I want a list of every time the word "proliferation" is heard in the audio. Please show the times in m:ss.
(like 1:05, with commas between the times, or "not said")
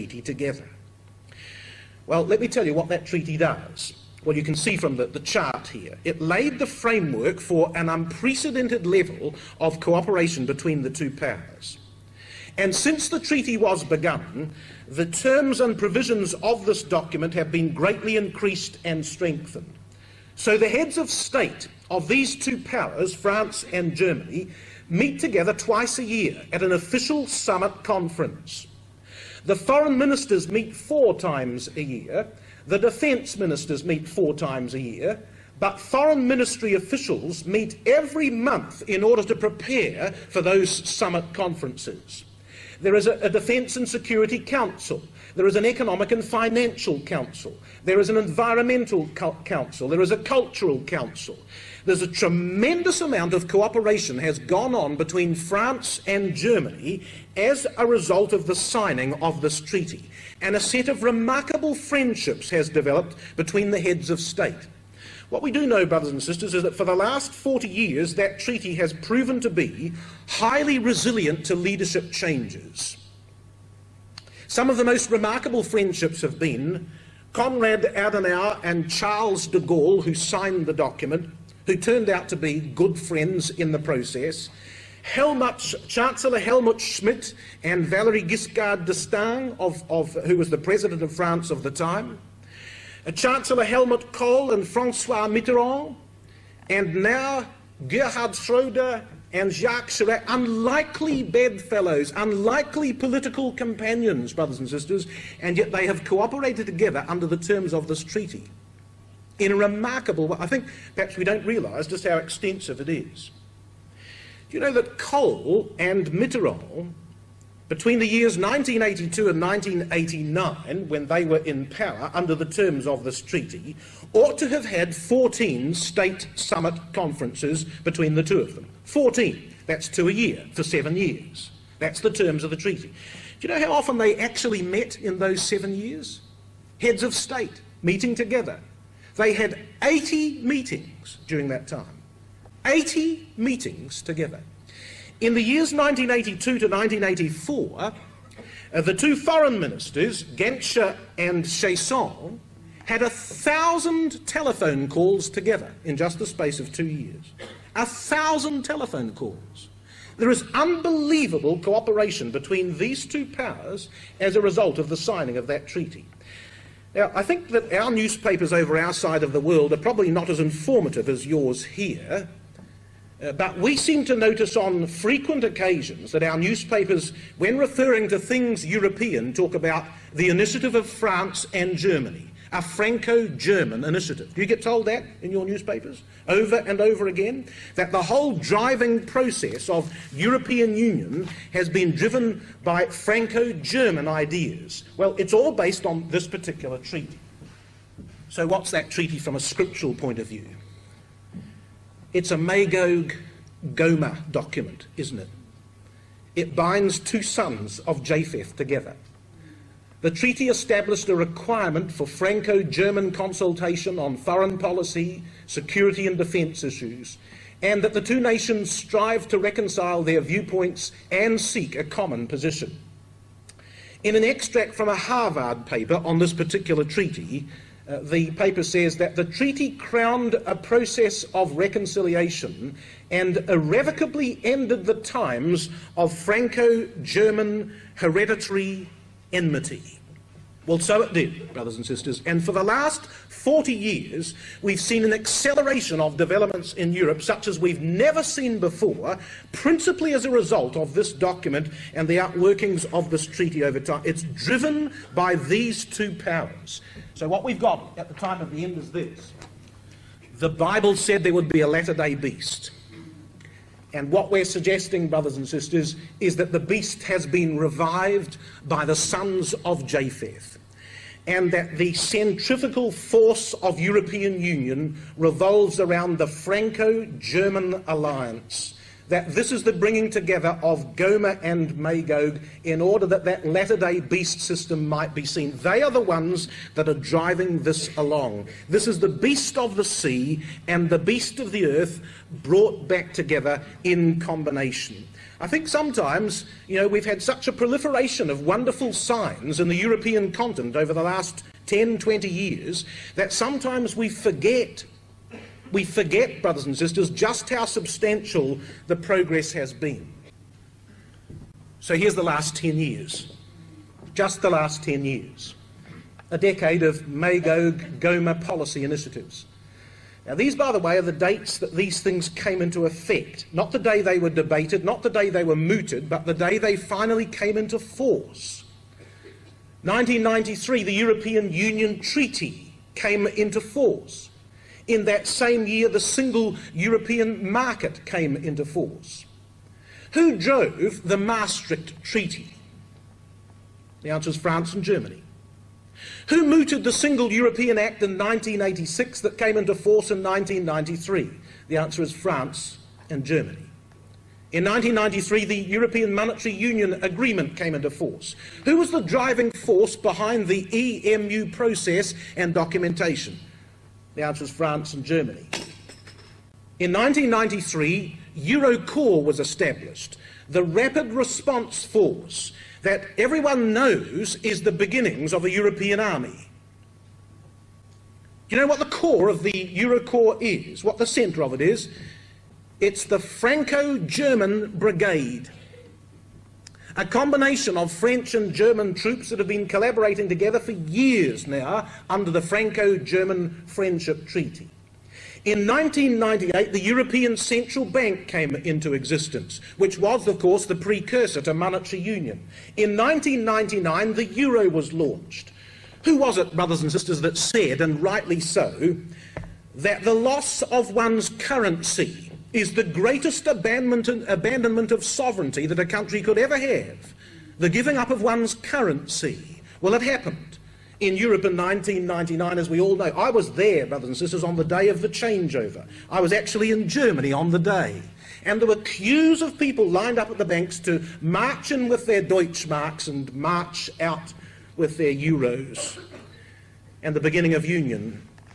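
4:57.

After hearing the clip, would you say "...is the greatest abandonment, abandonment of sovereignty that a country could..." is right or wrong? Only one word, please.
right.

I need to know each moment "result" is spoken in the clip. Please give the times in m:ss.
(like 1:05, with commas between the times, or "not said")
0:57, 2:44, 4:10.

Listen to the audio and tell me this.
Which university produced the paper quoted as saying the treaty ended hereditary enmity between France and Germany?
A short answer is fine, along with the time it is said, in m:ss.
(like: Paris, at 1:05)
Harvard, at 3:44.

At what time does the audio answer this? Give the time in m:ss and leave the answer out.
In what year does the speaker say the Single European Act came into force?
5:48.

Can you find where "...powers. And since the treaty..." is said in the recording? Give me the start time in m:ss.
0:11.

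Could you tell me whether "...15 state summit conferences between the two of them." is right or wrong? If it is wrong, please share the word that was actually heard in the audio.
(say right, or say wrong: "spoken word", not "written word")
wrong: "14", not "15".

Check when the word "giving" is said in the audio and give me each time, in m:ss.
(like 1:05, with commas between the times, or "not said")
6:57.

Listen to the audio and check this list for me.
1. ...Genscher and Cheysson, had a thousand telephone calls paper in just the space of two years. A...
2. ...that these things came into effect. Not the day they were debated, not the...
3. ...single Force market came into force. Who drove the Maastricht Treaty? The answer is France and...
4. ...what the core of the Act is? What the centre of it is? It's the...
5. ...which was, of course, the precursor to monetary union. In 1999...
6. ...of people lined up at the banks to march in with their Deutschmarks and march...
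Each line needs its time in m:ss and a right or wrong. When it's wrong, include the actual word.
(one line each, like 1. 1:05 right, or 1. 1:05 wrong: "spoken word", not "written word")
1. 2:30 wrong: "together", not "paper"
2. 5:21 right
3. 5:35 wrong: "European", not "Force"
4. 6:18 wrong: "Eurocorps", not "Act"
5. 6:39 right
6. 7:09 right.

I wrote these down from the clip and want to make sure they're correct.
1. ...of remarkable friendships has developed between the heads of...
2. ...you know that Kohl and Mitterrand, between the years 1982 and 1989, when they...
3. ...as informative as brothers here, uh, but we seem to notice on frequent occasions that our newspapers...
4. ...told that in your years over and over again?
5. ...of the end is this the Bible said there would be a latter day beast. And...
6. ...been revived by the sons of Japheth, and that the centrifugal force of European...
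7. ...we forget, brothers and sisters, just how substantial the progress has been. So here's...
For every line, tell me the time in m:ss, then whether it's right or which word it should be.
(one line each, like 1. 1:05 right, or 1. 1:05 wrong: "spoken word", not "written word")
1. 1:00 right
2. 1:54 right
3. 2:50 wrong: "yours", not "brothers"
4. 3:04 wrong: "newspapers", not "years"
5. 4:18 right
6. 4:27 right
7. 5:05 right.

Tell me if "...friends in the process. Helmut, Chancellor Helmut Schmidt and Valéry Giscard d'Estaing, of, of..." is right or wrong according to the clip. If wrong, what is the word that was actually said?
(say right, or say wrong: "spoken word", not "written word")
right.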